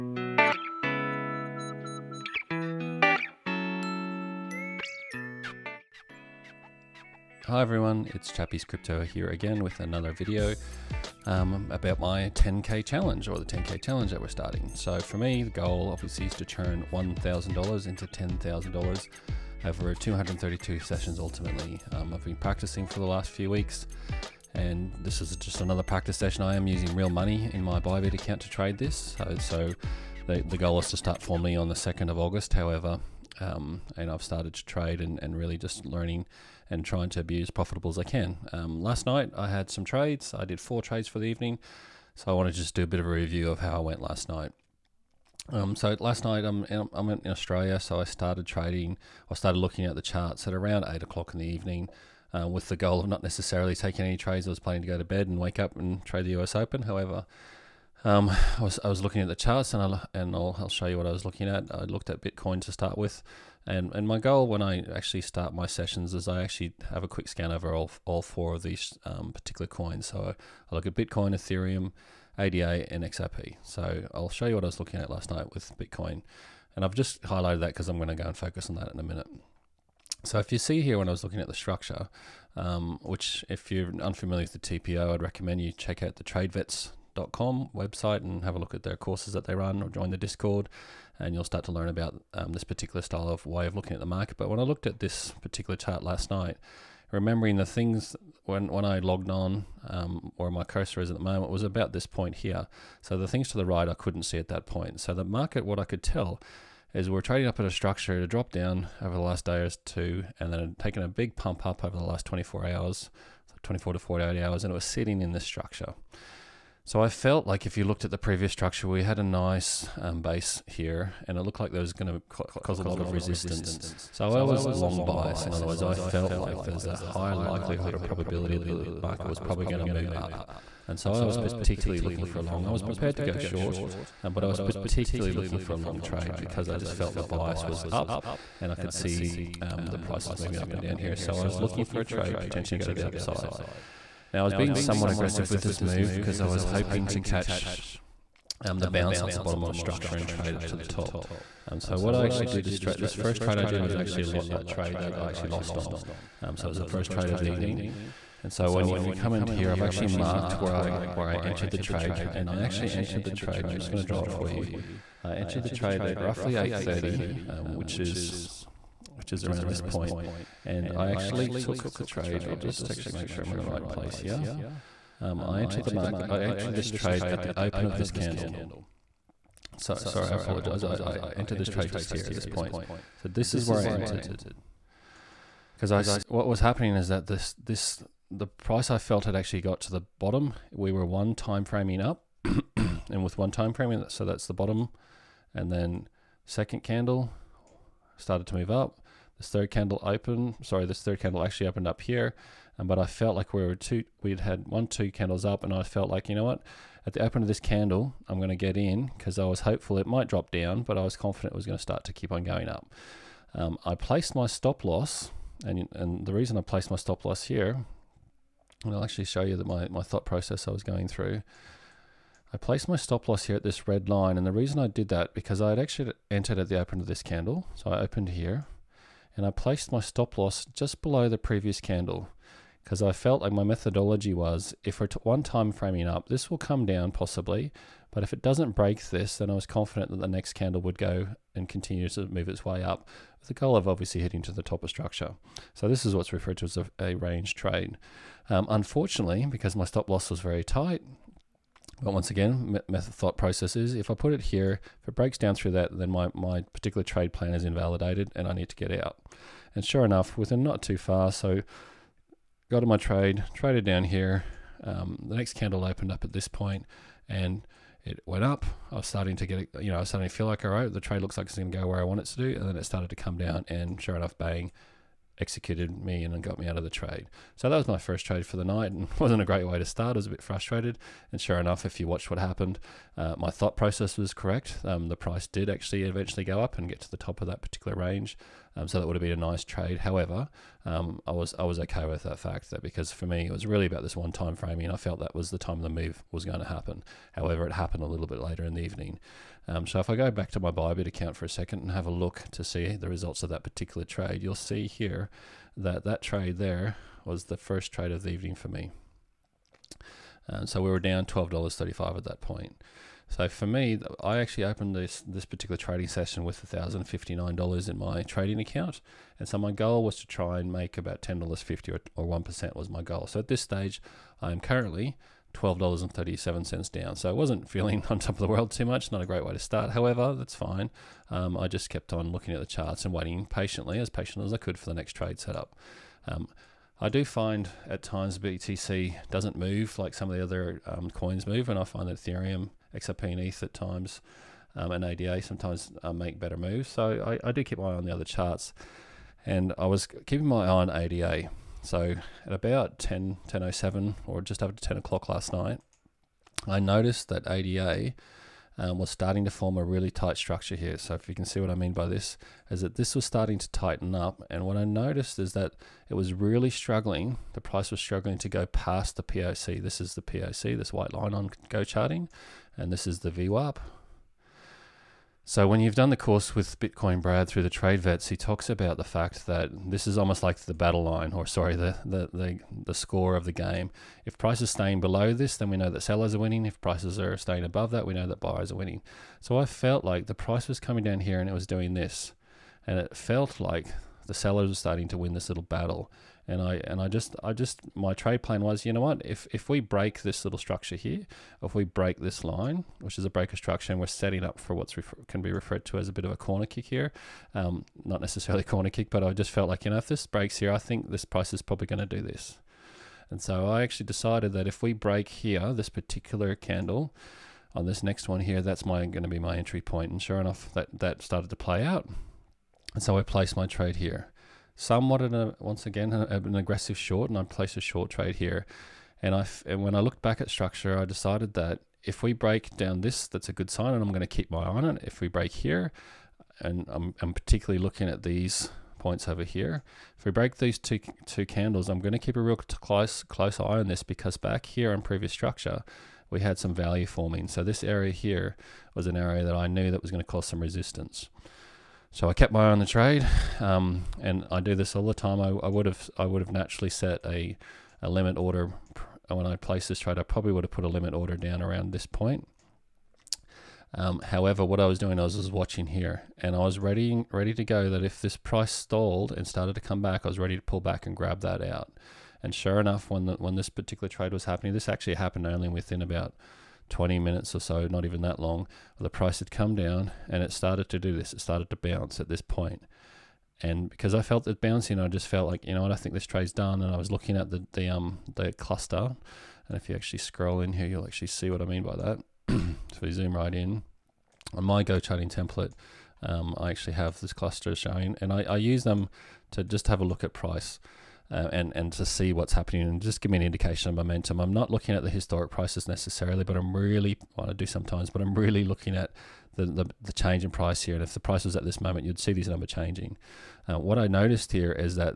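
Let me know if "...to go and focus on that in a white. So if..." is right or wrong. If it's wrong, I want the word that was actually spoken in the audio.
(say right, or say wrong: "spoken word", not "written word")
wrong: "minute", not "white".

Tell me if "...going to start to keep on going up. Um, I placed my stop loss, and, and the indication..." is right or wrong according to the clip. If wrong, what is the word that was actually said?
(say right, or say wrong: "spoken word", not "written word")
wrong: "reason", not "indication".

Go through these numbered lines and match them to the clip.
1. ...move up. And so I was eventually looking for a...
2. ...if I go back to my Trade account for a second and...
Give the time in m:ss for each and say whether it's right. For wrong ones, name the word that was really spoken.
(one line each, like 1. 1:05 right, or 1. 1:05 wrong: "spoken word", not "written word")
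1. 2:09 wrong: "particularly", not "eventually"
2. 4:59 wrong: "Bybit", not "Trade".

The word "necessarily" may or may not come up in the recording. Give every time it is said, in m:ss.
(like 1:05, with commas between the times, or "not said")
0:53, 6:48, 8:25.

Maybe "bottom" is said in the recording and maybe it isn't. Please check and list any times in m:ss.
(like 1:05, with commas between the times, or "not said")
2:29, 3:10, 3:14.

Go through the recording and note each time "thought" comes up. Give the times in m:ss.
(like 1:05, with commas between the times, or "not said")
3:40, 4:13, 4:43.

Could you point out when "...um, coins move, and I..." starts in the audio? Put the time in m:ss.
5:40.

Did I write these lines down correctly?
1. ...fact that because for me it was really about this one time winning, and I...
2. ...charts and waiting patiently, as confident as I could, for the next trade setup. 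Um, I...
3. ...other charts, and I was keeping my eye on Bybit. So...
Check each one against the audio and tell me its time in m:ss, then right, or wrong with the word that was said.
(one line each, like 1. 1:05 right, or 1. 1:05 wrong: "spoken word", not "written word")
1. 4:52 wrong: "framing", not "winning"
2. 5:32 wrong: "patient", not "confident"
3. 5:48 wrong: "ADA", not "Bybit".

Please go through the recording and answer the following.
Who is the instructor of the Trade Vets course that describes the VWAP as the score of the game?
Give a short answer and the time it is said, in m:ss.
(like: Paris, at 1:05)
Bitcoin Brad, at 6:16.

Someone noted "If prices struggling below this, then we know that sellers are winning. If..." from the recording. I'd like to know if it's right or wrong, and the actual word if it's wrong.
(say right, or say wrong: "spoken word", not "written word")
wrong: "staying", not "struggling".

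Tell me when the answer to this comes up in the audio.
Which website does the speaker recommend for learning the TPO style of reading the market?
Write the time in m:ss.
1:26.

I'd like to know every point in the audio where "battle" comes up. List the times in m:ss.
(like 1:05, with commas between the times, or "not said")
6:20, 6:35.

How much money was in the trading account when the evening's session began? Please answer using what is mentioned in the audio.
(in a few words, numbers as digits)
$1,059.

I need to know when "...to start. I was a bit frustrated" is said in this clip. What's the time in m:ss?
4:39.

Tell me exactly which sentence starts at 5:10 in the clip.
Um, so we were down twelve dollars thirty five at that point.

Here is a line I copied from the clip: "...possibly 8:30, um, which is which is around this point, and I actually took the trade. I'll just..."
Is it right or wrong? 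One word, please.
wrong.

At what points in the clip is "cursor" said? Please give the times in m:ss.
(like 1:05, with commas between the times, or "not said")
1:40.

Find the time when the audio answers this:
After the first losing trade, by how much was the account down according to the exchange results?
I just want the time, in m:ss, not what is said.
5:25.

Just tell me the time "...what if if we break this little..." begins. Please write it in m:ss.
6:39.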